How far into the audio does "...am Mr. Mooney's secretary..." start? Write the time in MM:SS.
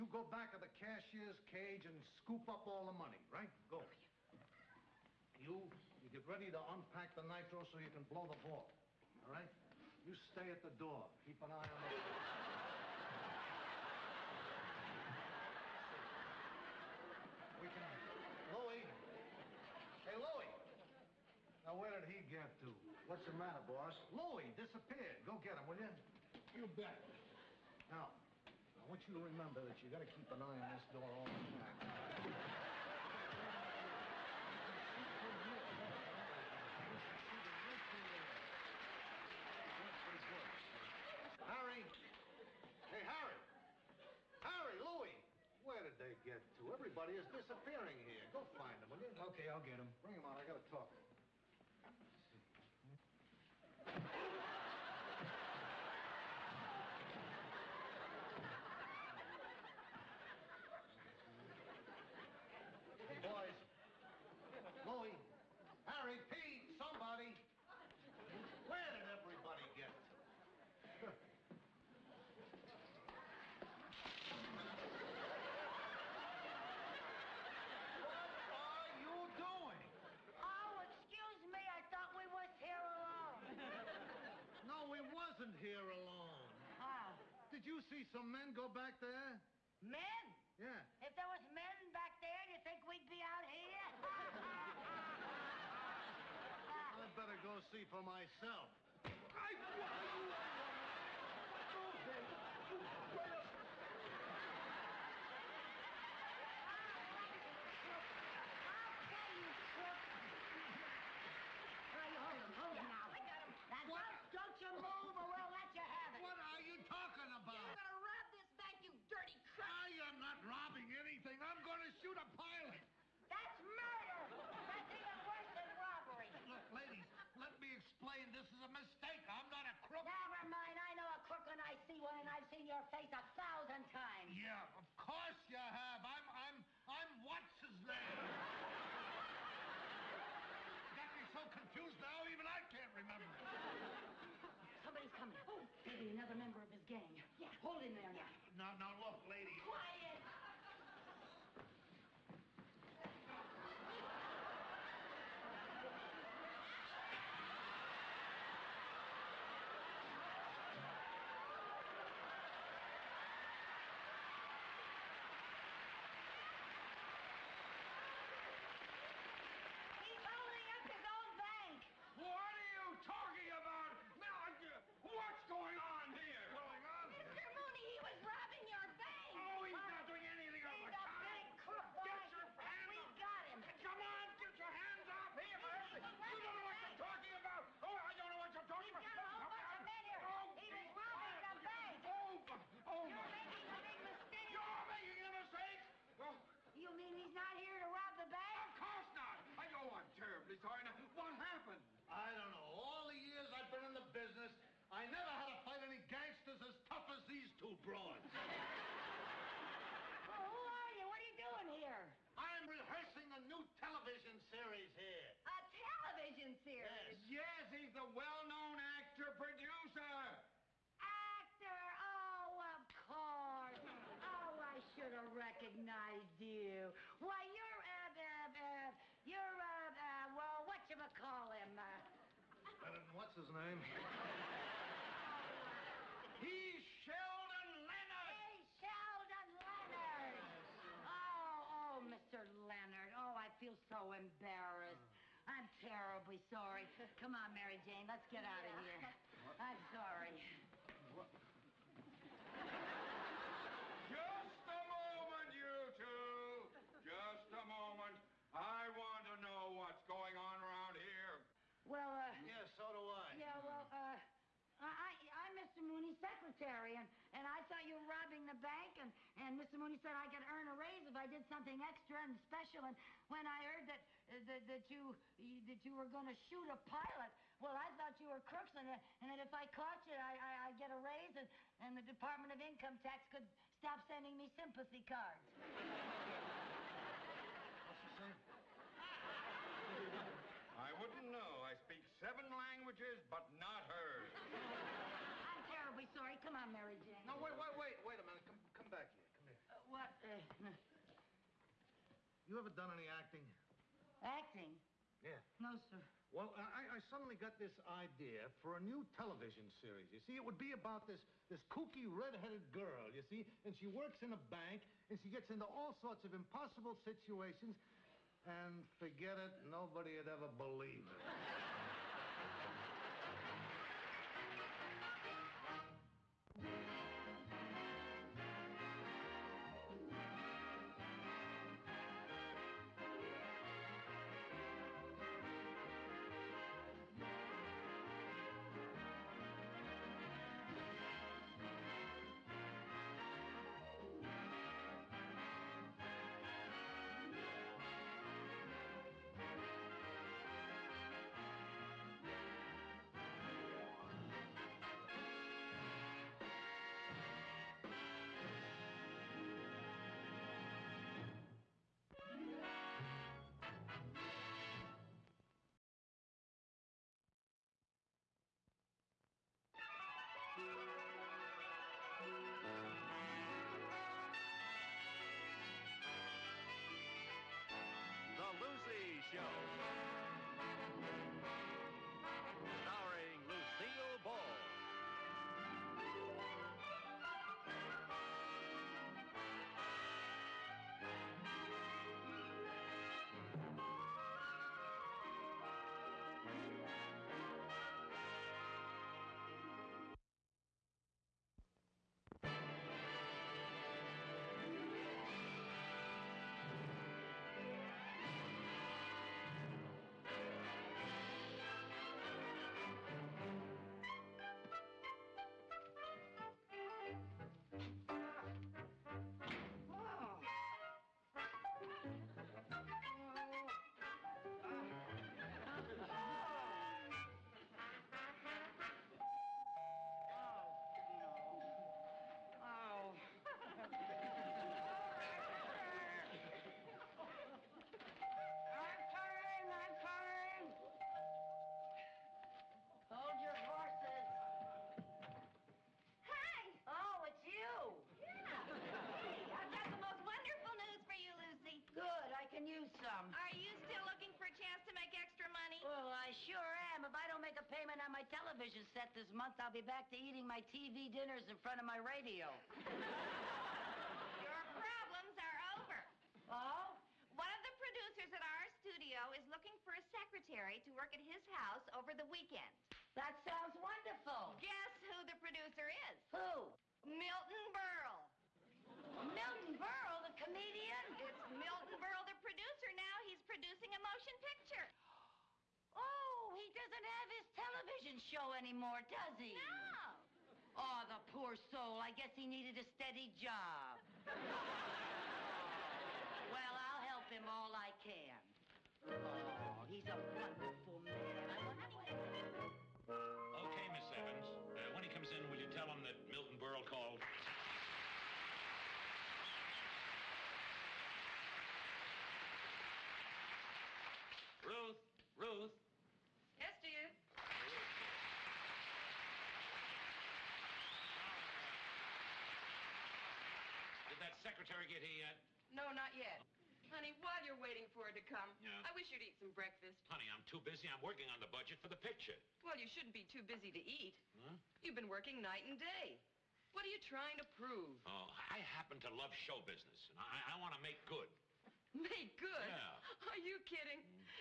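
04:25.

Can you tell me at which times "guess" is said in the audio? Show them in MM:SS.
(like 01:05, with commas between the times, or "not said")
07:54, 08:12.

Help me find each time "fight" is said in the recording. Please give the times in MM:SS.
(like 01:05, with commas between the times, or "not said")
03:25.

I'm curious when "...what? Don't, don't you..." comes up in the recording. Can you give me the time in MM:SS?
01:53.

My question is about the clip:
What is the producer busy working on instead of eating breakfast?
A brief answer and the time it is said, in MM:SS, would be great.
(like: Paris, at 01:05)
The budget, at 08:51.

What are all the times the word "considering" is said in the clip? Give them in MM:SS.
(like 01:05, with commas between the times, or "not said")
not said.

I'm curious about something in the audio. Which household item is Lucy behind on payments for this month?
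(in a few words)
Television set.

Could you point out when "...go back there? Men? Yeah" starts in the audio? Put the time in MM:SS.
01:28.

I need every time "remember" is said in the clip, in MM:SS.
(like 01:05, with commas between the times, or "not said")
00:29, 02:22.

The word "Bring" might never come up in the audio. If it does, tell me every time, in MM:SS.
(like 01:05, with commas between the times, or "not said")
00:50.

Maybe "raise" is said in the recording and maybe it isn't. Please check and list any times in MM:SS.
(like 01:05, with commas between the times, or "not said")
04:30, 04:40.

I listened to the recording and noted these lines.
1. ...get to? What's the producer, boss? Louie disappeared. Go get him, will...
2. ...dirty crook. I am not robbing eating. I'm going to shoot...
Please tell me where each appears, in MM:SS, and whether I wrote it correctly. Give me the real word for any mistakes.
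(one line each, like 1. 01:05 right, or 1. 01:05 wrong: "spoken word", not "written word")
1. 00:22 wrong: "matter", not "producer"
2. 01:59 wrong: "anything", not "eating".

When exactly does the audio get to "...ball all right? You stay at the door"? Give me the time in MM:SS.
00:08.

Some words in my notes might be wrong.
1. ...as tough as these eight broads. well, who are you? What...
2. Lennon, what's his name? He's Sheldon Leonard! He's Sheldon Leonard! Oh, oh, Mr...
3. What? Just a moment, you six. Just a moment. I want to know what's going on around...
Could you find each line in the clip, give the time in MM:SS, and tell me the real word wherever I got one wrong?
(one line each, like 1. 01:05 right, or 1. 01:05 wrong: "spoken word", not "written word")
1. 03:26 wrong: "two", not "eight"
2. 03:52 right
3. 04:11 wrong: "two", not "six".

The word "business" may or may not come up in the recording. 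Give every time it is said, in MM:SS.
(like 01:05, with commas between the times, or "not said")
03:24, 08:59.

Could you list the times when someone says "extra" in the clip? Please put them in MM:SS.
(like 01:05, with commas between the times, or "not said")
04:31, 07:35.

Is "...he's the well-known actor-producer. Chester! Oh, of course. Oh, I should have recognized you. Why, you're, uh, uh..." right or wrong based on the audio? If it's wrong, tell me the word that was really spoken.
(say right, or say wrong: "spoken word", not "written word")
right.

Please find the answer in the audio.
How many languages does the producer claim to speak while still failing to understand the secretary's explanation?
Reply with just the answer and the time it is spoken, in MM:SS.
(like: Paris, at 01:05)
7, at 04:52.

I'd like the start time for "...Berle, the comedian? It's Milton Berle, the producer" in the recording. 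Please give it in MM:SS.
07:59.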